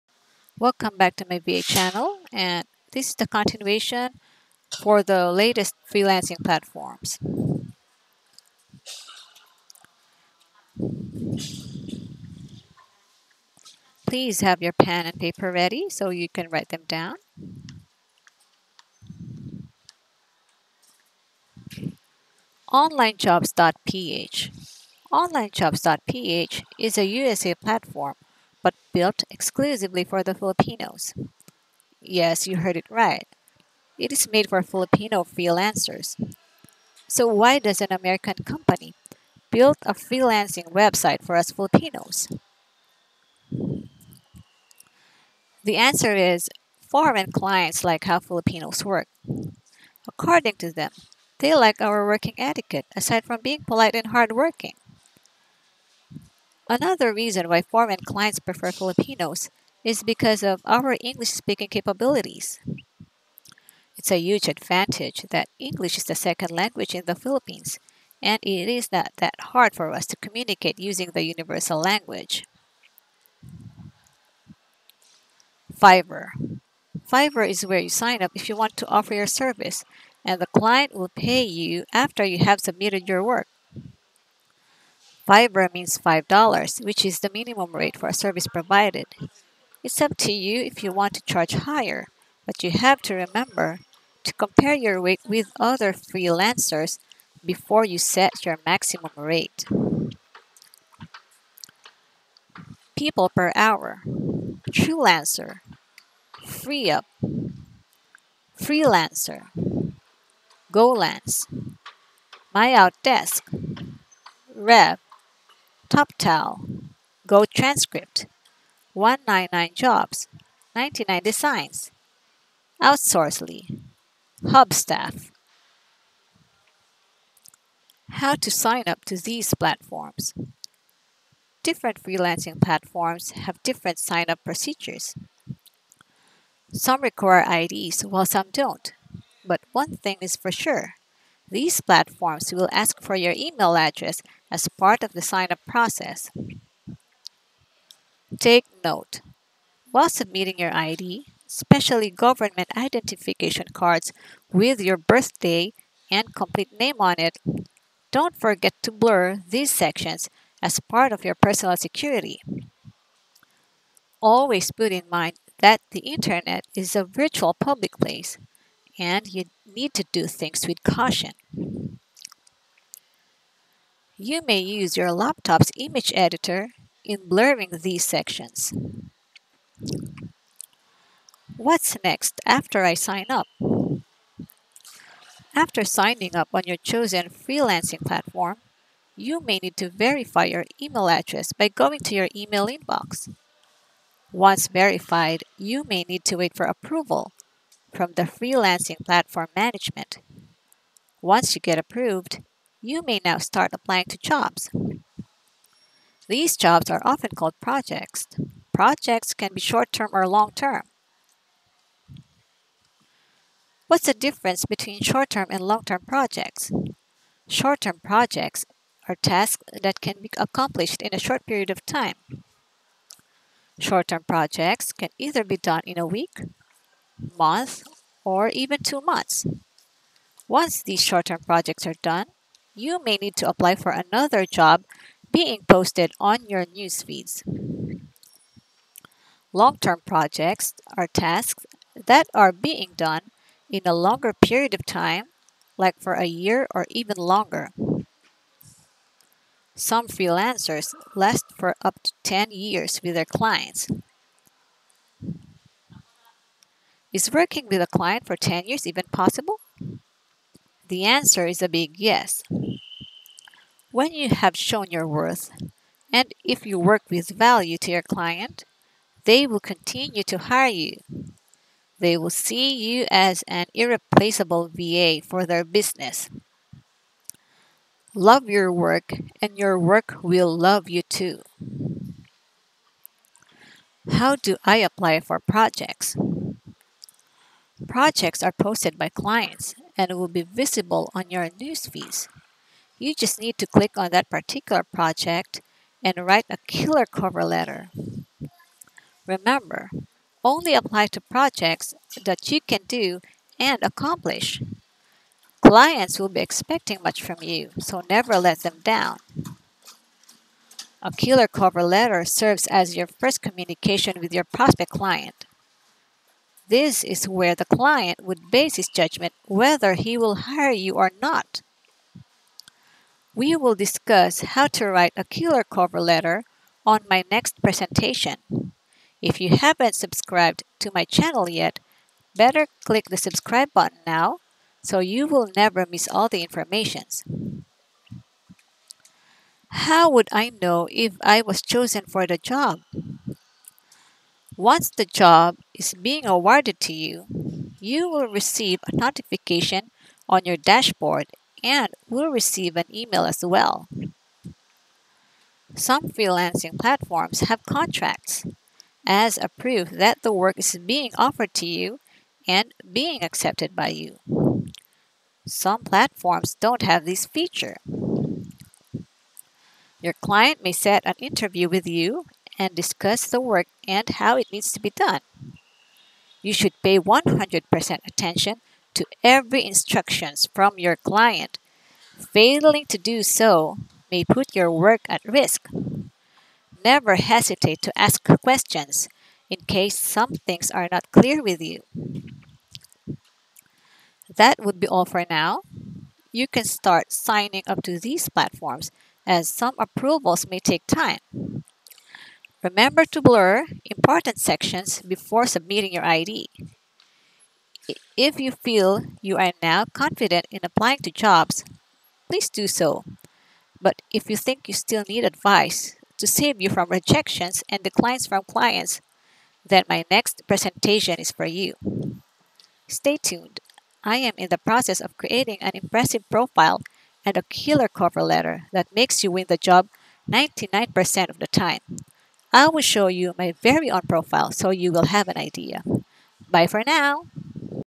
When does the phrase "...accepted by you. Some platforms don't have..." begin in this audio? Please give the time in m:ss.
6:03.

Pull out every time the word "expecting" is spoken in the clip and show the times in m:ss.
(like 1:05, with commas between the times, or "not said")
5:06.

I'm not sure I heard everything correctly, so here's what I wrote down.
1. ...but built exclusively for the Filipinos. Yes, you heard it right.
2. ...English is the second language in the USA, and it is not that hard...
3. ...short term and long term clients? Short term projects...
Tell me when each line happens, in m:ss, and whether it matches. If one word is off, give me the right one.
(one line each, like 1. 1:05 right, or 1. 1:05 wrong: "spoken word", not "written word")
1. 0:28 right
2. 1:05 wrong: "Philippines", not "USA"
3. 3:35 wrong: "projects", not "clients".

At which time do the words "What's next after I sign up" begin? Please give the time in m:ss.
3:01.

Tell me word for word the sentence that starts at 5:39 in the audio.
How would I know if I was chosen for the job?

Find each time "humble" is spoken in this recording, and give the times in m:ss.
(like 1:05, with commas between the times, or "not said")
not said.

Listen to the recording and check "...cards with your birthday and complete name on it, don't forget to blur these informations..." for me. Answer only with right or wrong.
wrong.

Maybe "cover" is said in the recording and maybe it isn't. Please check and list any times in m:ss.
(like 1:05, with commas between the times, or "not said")
4:57, 5:11, 5:25, 7:07.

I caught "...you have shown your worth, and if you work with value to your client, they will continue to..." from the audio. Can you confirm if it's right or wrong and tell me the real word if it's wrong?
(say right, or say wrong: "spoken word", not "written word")
right.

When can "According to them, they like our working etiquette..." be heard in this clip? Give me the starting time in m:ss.
0:50.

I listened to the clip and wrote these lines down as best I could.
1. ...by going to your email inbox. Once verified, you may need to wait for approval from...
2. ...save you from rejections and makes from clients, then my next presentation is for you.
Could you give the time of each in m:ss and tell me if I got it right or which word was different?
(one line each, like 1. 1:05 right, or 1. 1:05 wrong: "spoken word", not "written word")
1. 3:11 right
2. 6:56 wrong: "declines", not "makes".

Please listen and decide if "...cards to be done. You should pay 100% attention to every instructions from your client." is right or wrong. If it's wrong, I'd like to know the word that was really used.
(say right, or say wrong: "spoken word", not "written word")
wrong: "needs", not "cards".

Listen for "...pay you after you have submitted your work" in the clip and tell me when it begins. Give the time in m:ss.
1:21.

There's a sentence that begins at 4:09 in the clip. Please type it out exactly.
Some freelancers last for up to 10 years with their clients, Is working with a client for 10 years even possible?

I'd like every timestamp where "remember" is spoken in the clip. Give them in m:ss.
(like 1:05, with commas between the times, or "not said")
1:33, 4:59, 6:42.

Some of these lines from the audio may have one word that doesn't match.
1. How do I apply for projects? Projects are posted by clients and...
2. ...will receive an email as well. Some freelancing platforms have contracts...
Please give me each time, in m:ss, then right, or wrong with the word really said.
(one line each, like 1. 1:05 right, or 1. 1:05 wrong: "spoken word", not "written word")
1. 4:44 right
2. 5:52 right.